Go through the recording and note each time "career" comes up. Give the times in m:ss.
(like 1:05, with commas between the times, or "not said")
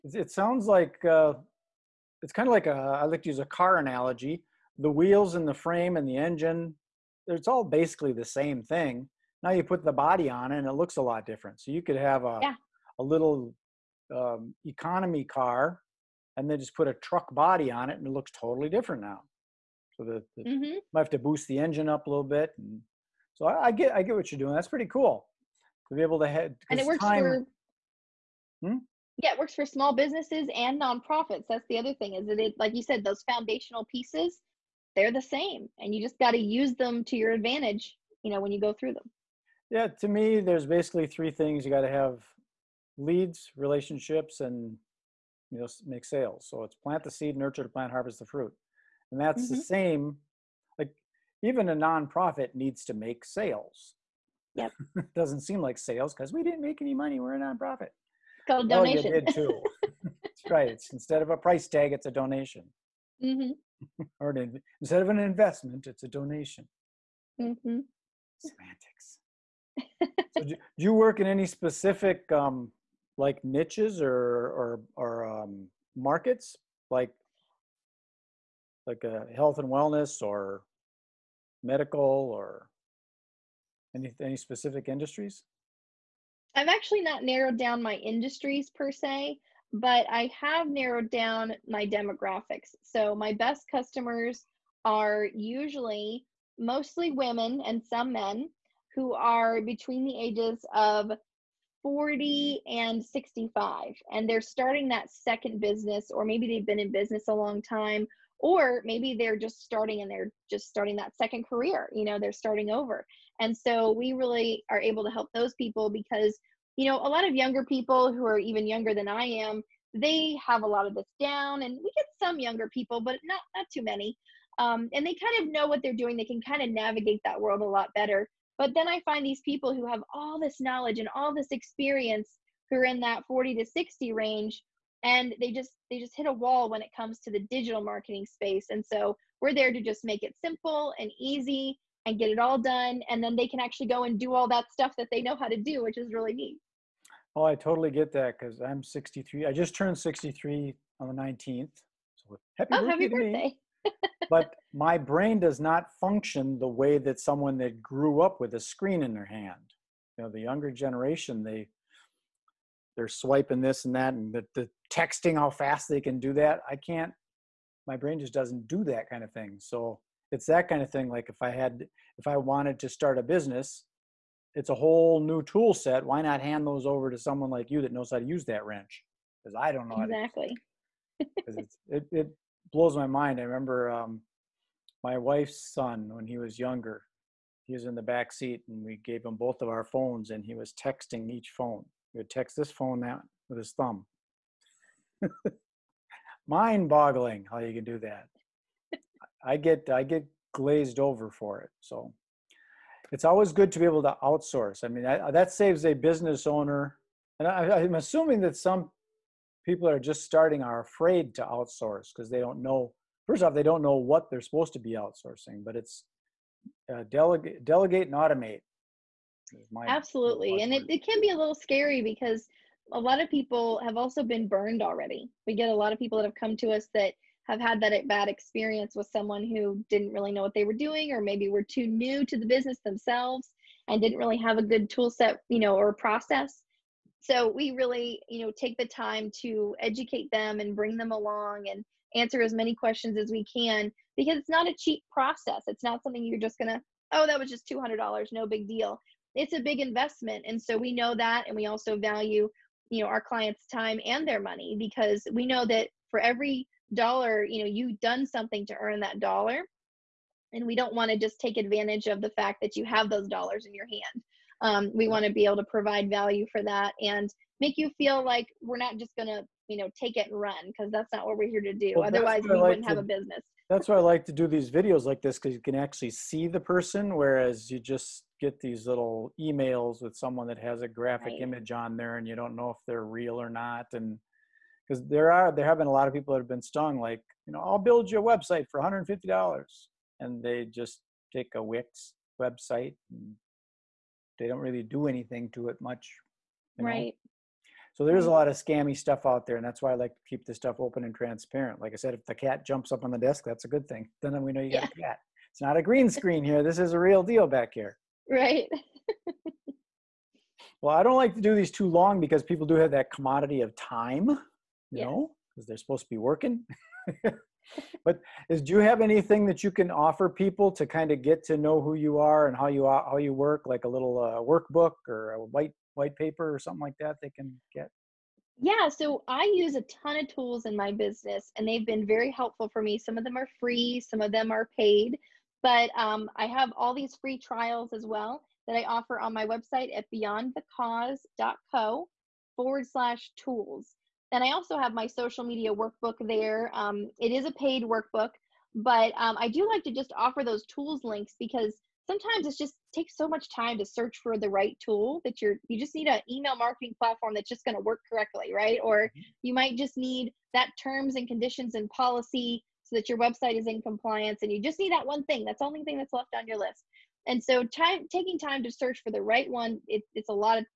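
1:51.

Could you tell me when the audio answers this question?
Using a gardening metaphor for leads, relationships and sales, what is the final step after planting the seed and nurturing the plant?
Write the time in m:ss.
0:47.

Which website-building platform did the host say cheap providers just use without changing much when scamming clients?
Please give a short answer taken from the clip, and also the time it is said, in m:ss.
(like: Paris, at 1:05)
Wix, at 4:51.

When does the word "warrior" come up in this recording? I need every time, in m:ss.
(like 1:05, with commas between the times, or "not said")
not said.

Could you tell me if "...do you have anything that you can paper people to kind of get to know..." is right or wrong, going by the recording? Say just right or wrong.
wrong.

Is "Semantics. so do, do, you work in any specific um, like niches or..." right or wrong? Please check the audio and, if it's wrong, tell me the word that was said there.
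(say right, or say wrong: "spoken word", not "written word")
right.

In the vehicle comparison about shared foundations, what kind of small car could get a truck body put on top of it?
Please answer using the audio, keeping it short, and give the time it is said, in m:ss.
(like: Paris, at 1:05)
economy car, at 0:14.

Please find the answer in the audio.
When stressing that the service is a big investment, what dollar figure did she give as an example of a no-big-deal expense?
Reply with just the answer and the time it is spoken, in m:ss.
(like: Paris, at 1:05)
$200, at 4:07.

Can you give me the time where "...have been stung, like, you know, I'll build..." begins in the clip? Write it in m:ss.
4:46.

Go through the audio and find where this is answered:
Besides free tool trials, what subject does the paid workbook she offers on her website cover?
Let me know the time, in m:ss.
5:45.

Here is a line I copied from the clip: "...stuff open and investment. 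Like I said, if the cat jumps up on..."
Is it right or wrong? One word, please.
wrong.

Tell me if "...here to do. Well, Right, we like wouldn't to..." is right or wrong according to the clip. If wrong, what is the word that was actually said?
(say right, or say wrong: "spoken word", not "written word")
wrong: "Otherwise", not "Right".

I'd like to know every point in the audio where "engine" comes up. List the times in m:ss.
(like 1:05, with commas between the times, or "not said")
0:06, 0:21.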